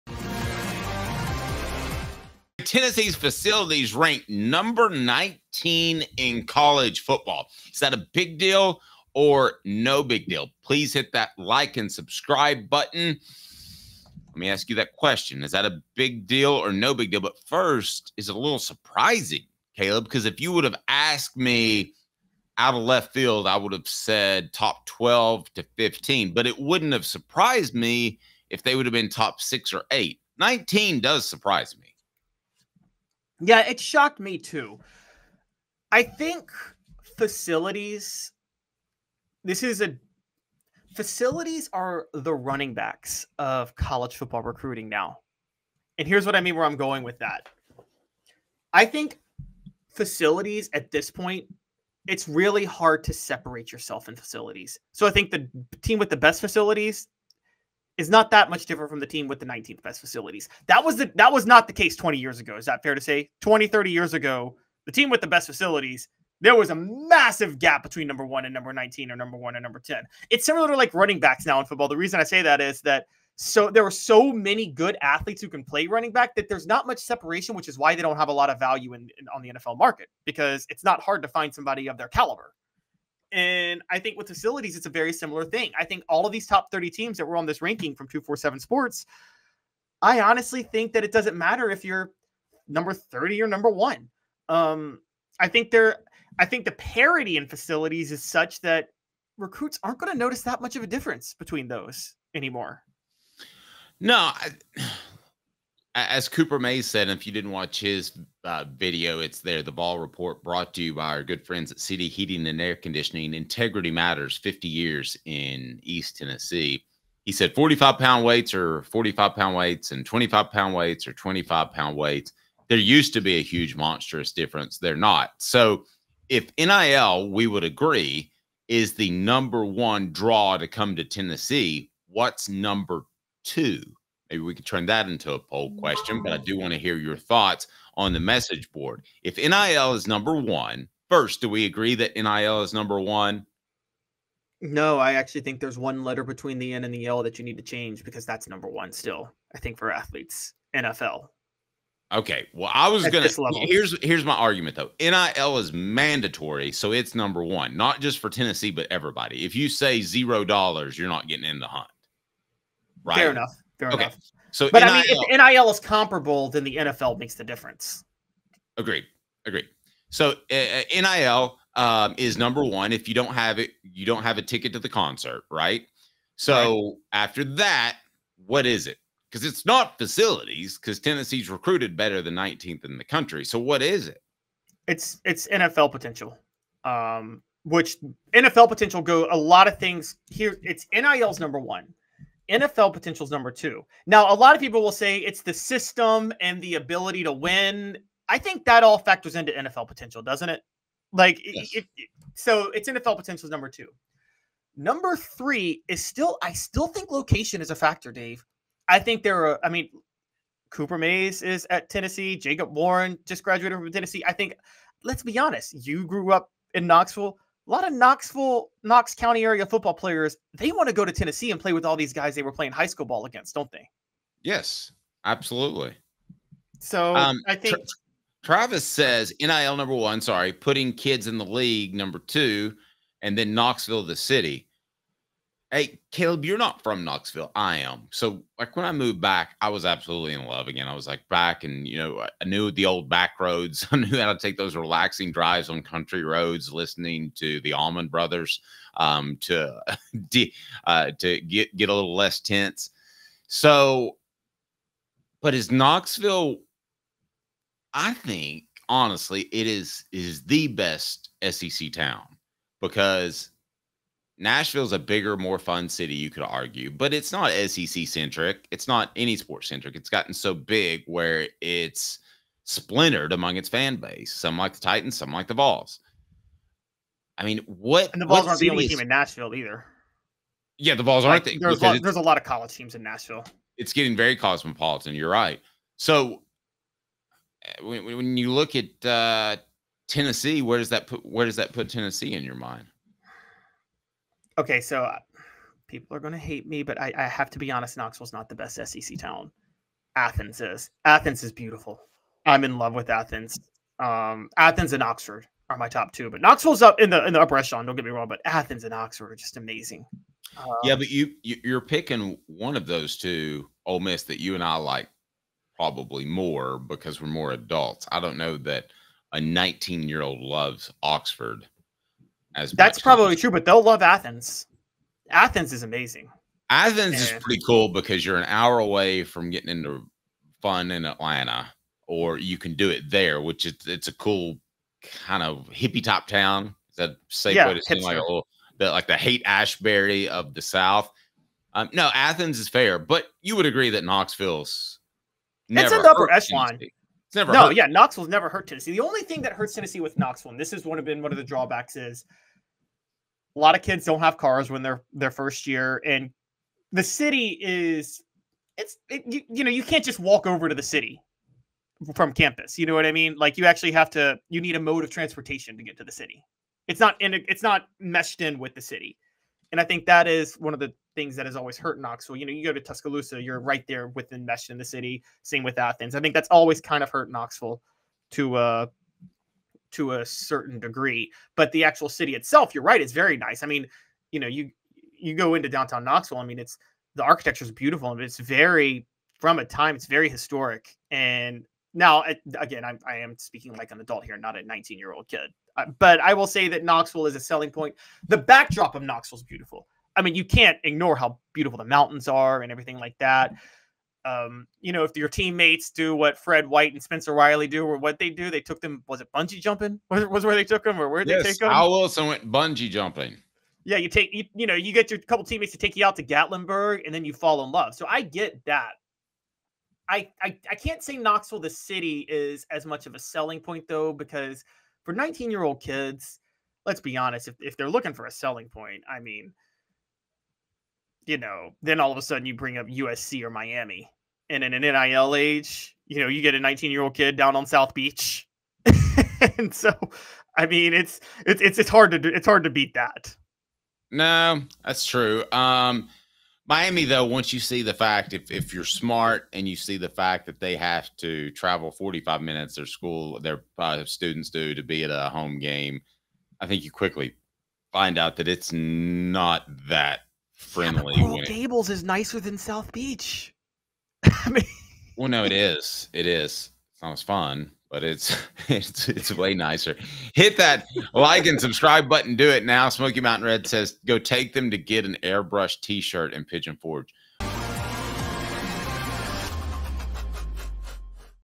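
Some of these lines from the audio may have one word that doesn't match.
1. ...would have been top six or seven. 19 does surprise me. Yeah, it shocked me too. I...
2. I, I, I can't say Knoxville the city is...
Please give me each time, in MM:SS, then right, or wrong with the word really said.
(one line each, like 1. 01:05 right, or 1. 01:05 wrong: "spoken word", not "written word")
1. 00:28 wrong: "eight", not "seven"
2. 07:00 right.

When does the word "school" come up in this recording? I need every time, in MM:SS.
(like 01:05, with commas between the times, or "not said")
03:42, 07:32.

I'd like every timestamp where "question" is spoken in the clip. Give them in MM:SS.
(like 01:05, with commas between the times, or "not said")
00:14, 02:15.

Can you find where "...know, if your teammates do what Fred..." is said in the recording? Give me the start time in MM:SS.
06:44.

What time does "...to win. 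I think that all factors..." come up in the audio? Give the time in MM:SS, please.
03:17.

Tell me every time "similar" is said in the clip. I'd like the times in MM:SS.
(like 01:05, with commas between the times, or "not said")
01:10, 01:25.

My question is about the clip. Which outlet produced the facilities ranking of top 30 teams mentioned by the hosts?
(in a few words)
247 Sports.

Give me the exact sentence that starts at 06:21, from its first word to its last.
But the actual city itself, you're right, it's very nice.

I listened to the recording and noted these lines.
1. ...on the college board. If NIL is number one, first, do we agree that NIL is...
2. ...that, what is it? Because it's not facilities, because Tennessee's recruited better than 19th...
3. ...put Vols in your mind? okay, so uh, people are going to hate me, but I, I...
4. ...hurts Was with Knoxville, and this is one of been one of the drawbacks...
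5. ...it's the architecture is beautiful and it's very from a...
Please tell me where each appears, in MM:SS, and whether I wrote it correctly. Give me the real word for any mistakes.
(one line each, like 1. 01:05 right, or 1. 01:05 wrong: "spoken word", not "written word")
1. 02:17 wrong: "message", not "college"
2. 02:57 right
3. 04:51 wrong: "Tennessee", not "Vols"
4. 05:49 wrong: "Tennessee", not "Was"
5. 06:26 right.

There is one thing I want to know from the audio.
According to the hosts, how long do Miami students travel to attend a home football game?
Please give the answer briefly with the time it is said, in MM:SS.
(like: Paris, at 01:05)
45 minutes, at 07:31.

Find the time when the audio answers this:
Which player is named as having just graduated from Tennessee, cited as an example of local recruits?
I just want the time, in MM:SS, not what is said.
03:32.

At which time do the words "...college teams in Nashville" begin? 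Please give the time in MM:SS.
04:42.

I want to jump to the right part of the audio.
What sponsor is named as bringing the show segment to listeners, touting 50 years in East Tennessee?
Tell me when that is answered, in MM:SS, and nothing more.
01:51.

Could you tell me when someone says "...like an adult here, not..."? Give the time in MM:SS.
06:33.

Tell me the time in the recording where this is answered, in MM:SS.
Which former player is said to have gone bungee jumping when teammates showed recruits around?
06:51.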